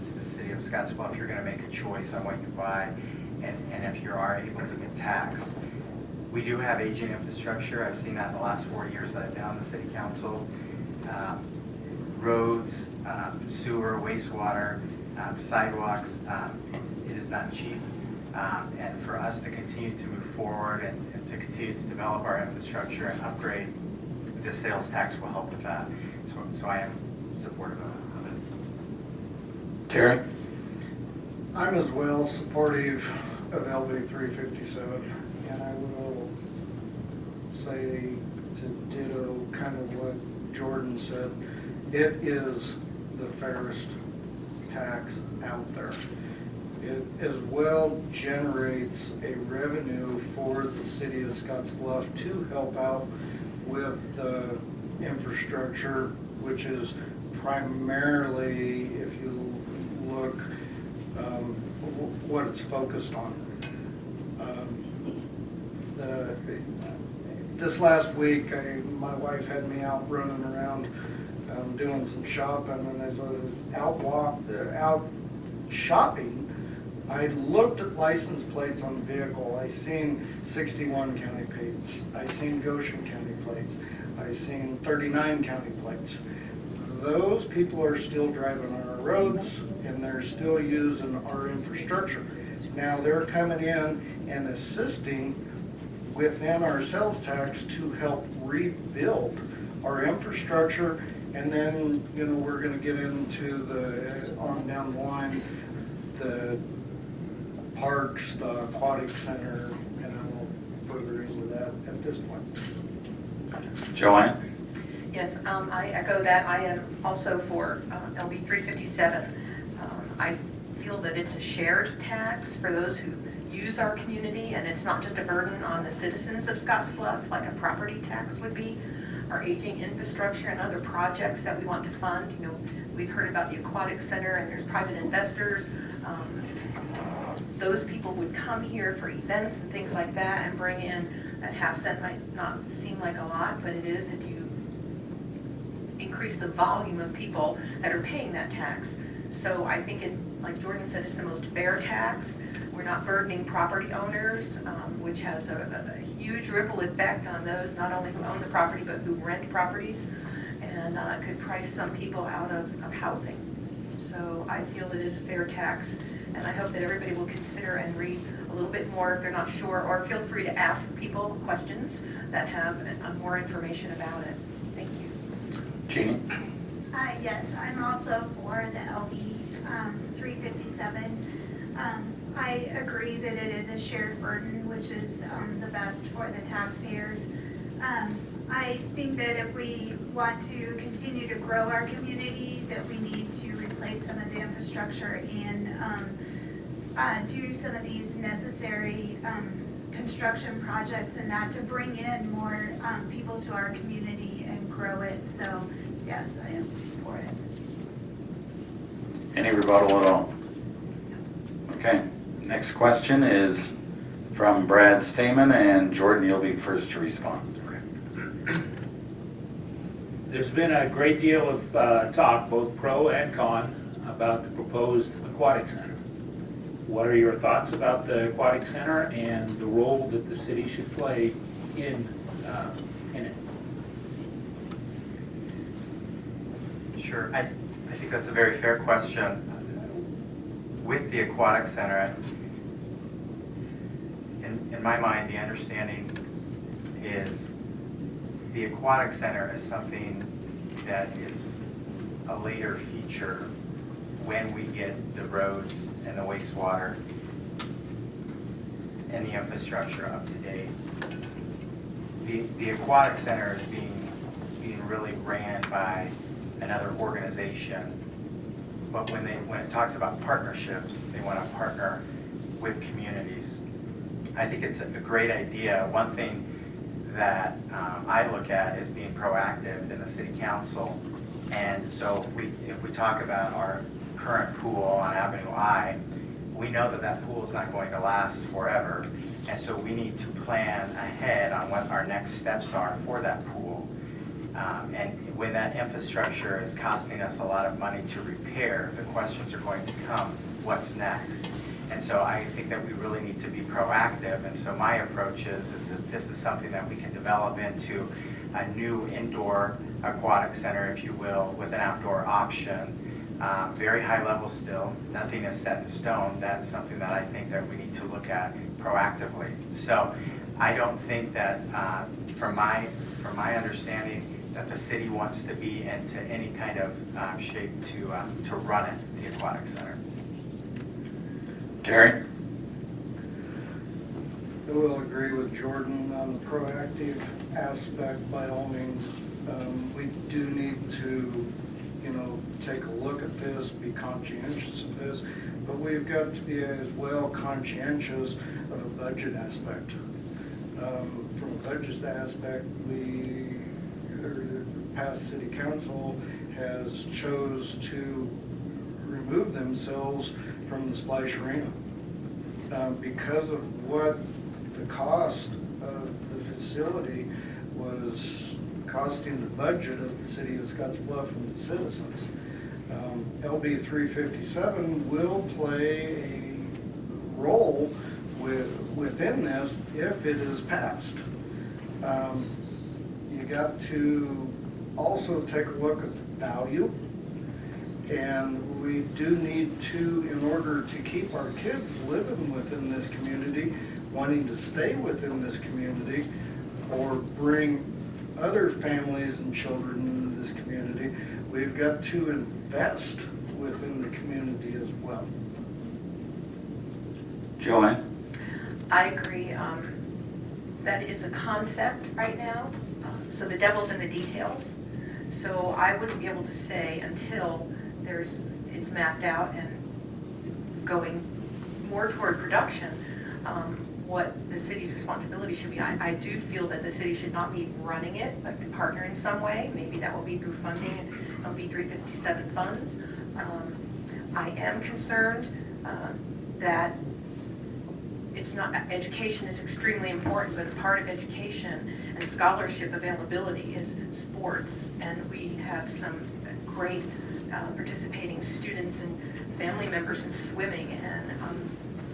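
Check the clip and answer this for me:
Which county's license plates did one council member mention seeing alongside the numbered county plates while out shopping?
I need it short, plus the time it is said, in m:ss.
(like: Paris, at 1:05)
Goshen County, at 1:22.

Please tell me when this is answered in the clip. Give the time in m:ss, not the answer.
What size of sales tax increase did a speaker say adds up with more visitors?
2:21.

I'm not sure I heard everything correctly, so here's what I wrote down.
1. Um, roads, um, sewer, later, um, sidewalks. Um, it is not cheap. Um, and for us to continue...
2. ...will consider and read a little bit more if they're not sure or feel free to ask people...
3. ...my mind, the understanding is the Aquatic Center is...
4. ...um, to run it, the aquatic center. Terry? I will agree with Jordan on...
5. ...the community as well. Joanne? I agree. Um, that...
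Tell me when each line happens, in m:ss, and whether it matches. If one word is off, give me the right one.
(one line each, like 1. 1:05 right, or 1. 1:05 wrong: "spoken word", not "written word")
1. 0:11 wrong: "wastewater", not "later"
2. 2:47 right
3. 4:04 right
4. 5:28 right
5. 6:44 right.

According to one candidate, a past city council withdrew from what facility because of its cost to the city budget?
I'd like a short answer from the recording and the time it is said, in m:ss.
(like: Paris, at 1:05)
the splash arena, at 6:00.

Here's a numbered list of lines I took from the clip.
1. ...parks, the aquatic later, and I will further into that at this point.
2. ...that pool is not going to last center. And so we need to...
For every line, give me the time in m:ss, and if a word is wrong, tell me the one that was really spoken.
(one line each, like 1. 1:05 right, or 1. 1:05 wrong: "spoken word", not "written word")
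1. 1:47 wrong: "center", not "later"
2. 4:47 wrong: "forever", not "center".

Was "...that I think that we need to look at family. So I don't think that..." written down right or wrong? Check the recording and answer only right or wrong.
wrong.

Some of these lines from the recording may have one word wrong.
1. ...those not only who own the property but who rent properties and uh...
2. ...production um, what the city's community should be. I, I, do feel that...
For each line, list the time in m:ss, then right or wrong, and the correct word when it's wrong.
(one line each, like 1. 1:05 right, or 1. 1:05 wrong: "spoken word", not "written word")
1. 2:37 right
2. 7:02 wrong: "responsibility", not "community".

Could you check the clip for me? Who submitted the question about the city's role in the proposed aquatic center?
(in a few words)
Brad Staman.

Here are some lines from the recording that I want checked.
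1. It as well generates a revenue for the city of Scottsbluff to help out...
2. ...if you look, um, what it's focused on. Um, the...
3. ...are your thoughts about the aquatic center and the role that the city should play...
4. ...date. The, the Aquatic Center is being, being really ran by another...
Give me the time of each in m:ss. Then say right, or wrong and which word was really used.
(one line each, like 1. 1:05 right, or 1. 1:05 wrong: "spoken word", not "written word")
1. 0:46 right
2. 0:58 right
3. 3:47 right
4. 4:20 right.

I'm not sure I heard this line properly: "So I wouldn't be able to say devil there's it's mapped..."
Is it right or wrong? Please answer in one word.
wrong.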